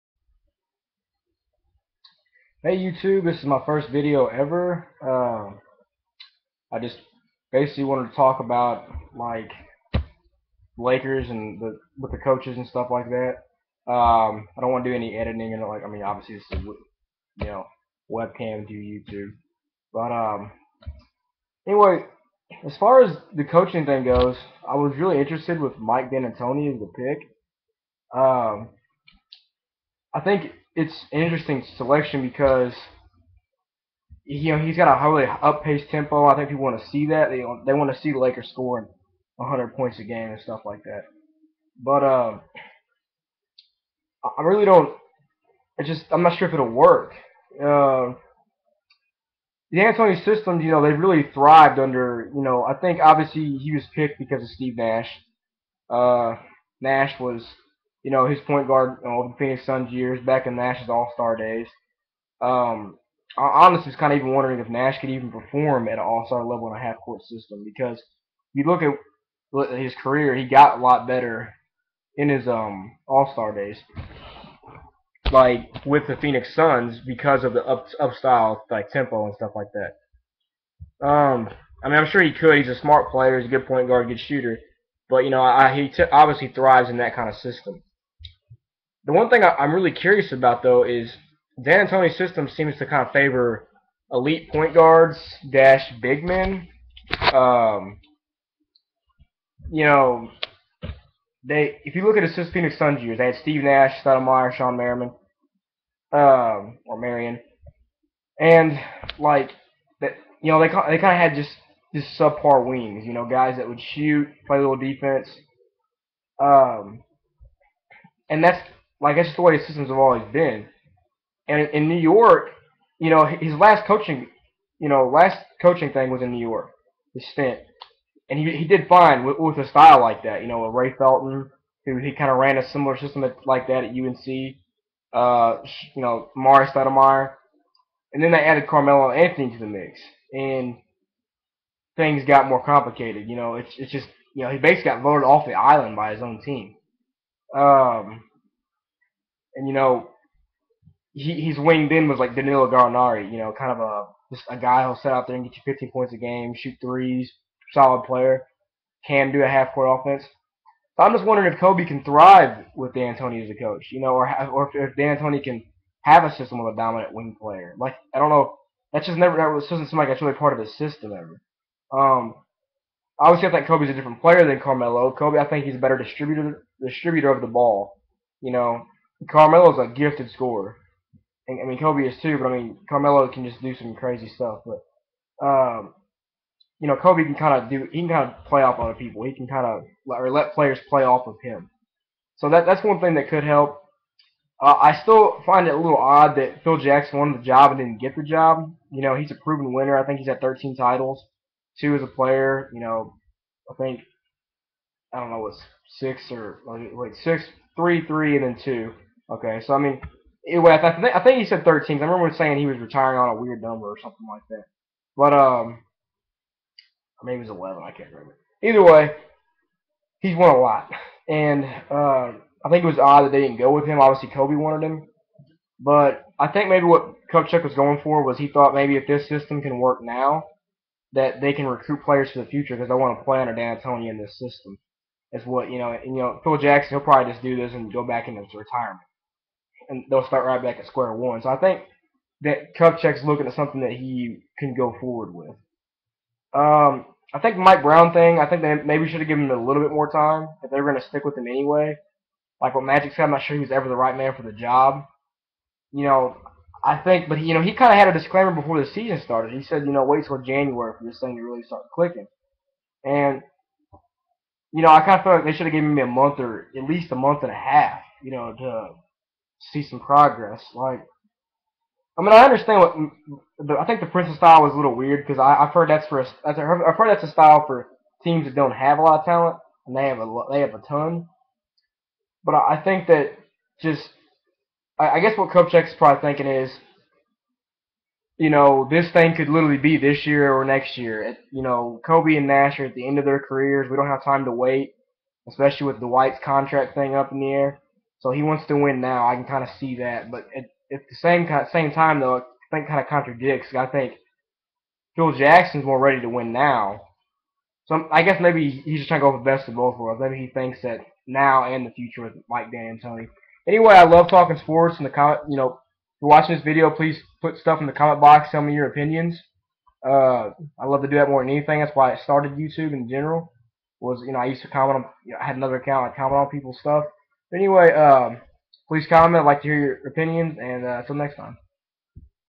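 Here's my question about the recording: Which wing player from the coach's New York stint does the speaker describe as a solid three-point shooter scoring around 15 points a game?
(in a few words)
Danilo Gallinari.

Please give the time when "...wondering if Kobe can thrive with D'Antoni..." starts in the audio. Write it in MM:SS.
02:41.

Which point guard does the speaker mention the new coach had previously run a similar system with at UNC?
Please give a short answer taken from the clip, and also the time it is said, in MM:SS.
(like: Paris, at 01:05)
Ray Felton, at 02:10.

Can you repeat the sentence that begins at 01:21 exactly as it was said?
Um, I mean, I'm sure he could.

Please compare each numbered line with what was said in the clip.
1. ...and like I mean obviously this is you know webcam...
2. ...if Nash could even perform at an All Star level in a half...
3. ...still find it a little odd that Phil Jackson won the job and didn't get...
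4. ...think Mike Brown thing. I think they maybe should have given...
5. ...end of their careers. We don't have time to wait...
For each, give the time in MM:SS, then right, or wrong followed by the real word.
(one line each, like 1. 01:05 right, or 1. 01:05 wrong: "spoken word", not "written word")
1. 00:15 right
2. 01:04 right
3. 03:15 right
4. 04:07 right
5. 04:53 right.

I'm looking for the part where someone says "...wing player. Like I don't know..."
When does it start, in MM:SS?
02:47.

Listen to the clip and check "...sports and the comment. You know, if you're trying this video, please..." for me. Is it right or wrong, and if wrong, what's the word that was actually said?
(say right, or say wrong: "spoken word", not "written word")
wrong: "watching", not "trying".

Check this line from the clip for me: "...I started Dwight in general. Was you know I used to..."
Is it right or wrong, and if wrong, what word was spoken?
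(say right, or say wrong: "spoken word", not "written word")
wrong: "YouTube", not "Dwight".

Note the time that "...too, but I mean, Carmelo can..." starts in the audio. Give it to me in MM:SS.
03:02.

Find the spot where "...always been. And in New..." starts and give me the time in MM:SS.
01:59.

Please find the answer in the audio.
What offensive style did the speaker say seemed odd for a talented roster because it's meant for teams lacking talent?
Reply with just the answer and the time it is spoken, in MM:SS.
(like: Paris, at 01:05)
Princeton style, at 04:34.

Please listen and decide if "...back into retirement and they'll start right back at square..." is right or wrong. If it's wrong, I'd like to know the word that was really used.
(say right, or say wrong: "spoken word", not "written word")
right.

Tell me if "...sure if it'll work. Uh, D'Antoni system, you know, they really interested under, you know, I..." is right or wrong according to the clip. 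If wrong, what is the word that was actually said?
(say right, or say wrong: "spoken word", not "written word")
wrong: "thrived", not "interested".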